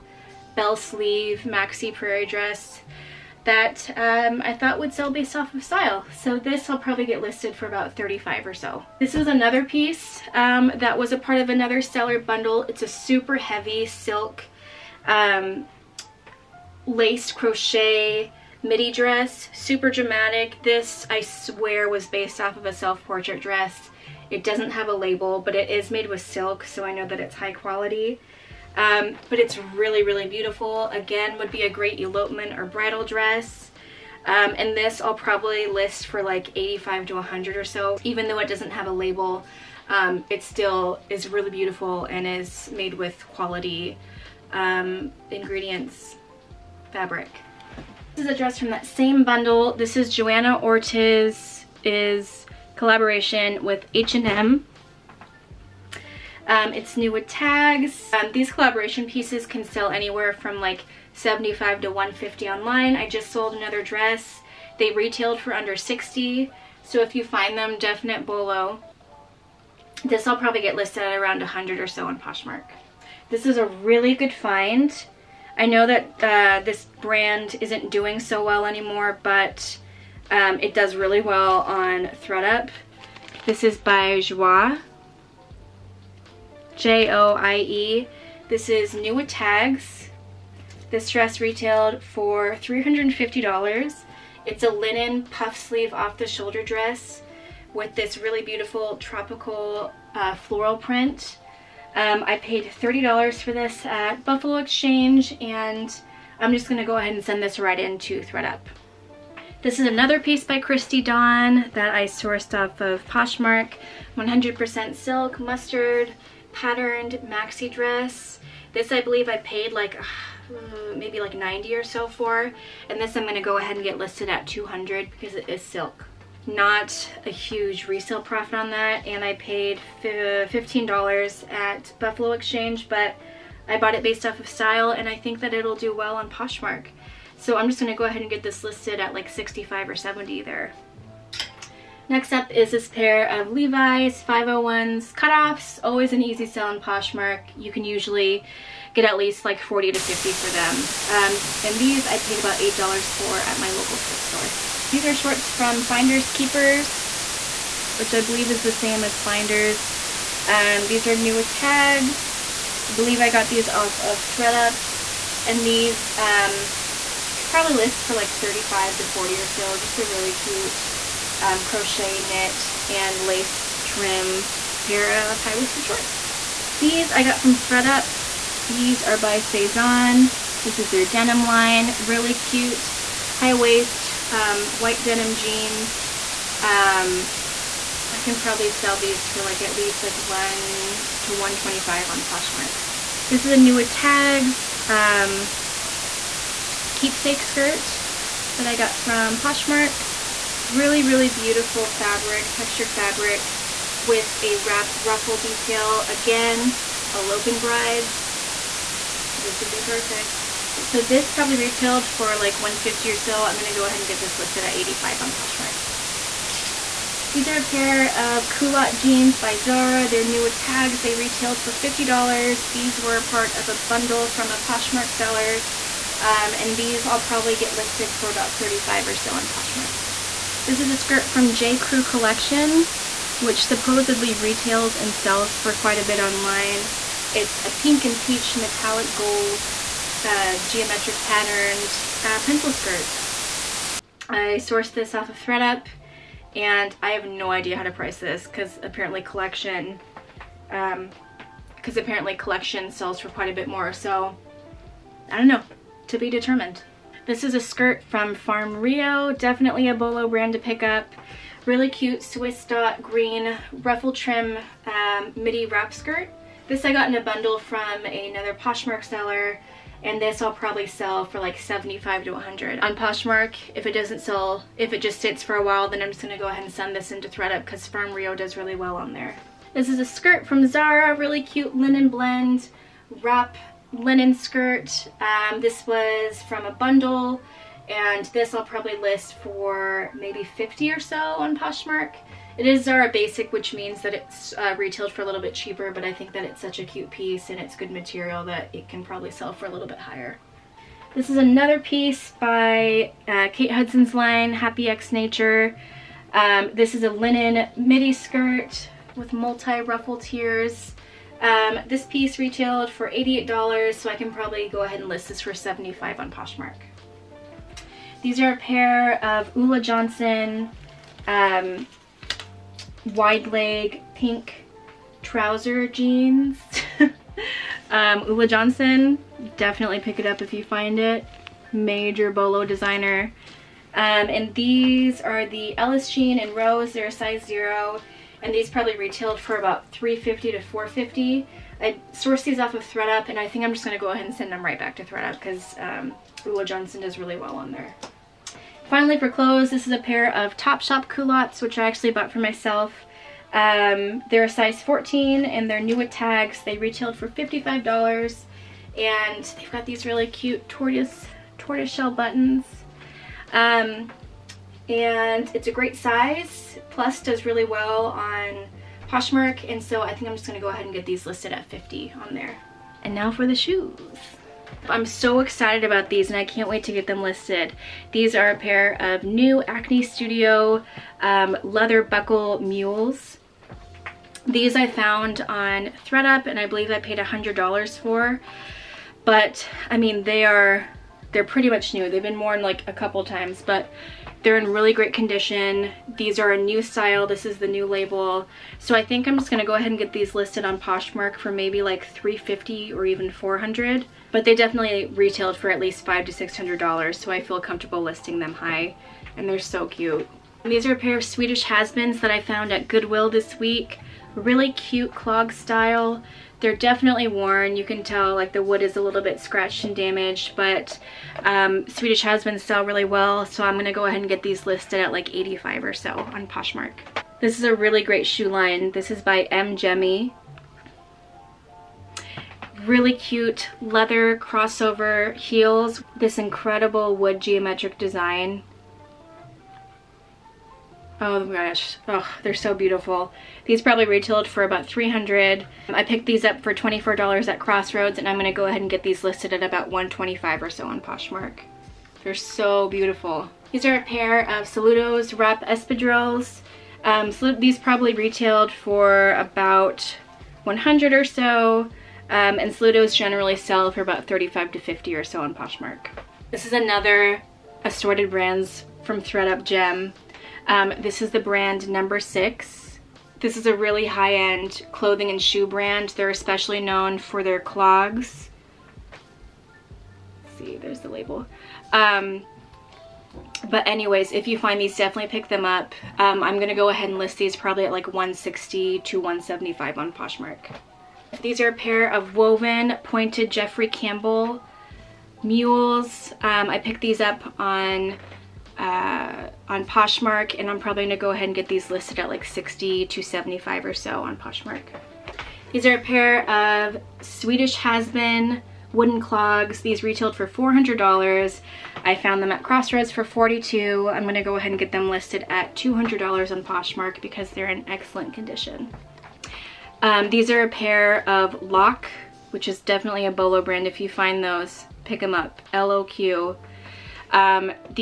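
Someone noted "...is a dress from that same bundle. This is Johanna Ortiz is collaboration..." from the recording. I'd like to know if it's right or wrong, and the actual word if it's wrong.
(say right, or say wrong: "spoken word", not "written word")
right.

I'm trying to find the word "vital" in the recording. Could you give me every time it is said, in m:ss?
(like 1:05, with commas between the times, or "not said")
not said.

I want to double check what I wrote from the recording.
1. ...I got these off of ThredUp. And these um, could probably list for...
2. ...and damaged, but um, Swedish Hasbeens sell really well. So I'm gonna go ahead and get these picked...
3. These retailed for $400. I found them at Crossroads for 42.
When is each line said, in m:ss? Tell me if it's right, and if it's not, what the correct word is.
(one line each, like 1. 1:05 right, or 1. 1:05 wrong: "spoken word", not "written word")
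1. 2:43 right
2. 6:59 wrong: "listed", not "picked"
3. 8:29 right.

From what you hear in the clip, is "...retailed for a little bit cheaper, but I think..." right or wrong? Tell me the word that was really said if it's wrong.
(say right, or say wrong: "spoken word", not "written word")
right.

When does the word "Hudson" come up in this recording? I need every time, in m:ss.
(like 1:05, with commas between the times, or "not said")
5:03.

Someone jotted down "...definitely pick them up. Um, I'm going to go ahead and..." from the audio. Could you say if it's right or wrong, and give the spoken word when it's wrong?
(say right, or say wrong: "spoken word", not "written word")
right.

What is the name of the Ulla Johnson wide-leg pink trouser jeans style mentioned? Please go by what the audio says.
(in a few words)
Ellis Jean.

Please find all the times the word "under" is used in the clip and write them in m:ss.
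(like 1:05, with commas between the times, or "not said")
1:05.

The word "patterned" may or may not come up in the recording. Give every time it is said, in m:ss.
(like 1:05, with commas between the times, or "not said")
1:56, 4:01.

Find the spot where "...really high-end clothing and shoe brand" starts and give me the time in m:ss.
7:53.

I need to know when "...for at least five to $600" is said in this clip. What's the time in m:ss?
6:45.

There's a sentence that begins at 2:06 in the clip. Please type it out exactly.
Not a huge resale profit on that.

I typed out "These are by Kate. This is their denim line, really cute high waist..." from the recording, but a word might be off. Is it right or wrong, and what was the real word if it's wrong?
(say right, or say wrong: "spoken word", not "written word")
wrong: "Sézane", not "Kate".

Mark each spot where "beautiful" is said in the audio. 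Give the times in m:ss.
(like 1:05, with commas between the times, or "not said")
0:30, 0:41, 1:38, 3:21, 7:22, 7:32.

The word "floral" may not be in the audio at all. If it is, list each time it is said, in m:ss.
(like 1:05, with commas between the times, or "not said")
1:40.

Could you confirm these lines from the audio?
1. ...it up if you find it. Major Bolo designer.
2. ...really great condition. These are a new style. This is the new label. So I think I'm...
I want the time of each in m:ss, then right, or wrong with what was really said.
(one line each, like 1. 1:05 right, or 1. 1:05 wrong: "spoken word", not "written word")
1. 5:30 right
2. 6:34 right.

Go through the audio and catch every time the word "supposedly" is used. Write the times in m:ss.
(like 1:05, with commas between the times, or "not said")
3:53.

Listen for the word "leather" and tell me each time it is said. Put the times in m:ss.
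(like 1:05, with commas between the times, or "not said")
6:21, 7:13.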